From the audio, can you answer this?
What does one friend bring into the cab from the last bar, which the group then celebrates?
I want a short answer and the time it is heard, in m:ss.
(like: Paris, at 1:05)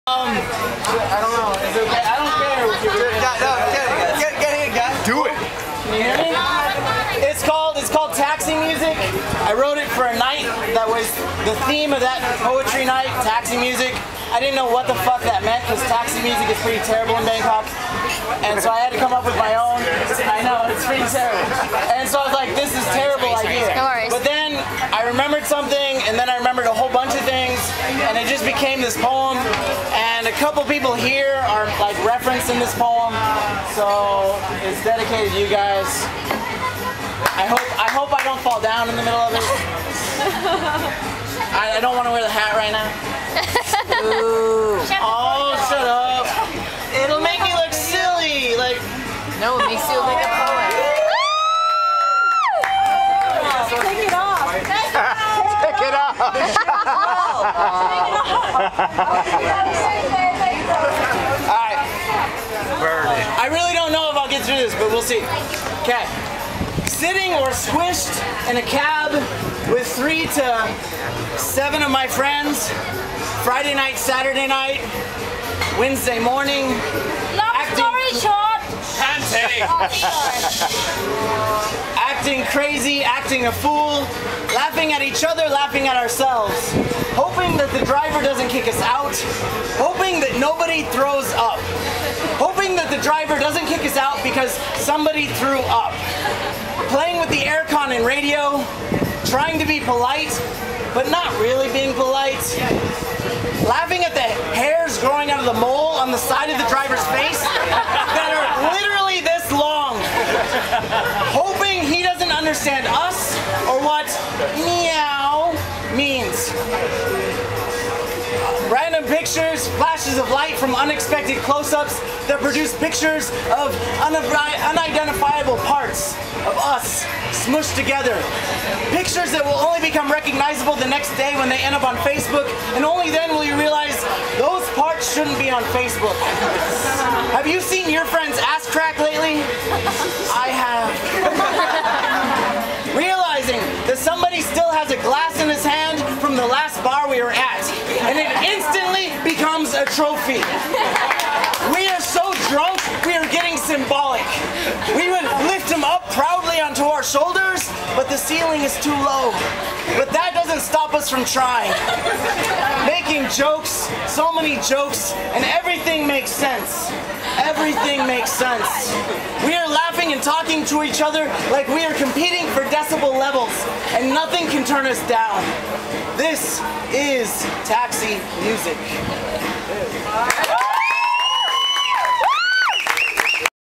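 A glass, at 2:24.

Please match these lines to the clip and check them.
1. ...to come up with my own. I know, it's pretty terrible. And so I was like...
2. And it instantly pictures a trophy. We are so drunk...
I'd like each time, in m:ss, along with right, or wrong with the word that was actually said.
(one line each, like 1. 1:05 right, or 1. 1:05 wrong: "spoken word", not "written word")
1. 0:18 right
2. 2:28 wrong: "becomes", not "pictures".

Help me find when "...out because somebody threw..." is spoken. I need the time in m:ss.
1:33.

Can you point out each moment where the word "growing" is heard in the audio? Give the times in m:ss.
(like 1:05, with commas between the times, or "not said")
1:45.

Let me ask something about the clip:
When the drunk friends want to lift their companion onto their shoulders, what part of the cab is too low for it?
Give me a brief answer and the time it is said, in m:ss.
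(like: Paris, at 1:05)
The ceiling, at 2:38.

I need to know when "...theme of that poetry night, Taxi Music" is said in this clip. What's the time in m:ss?
0:11.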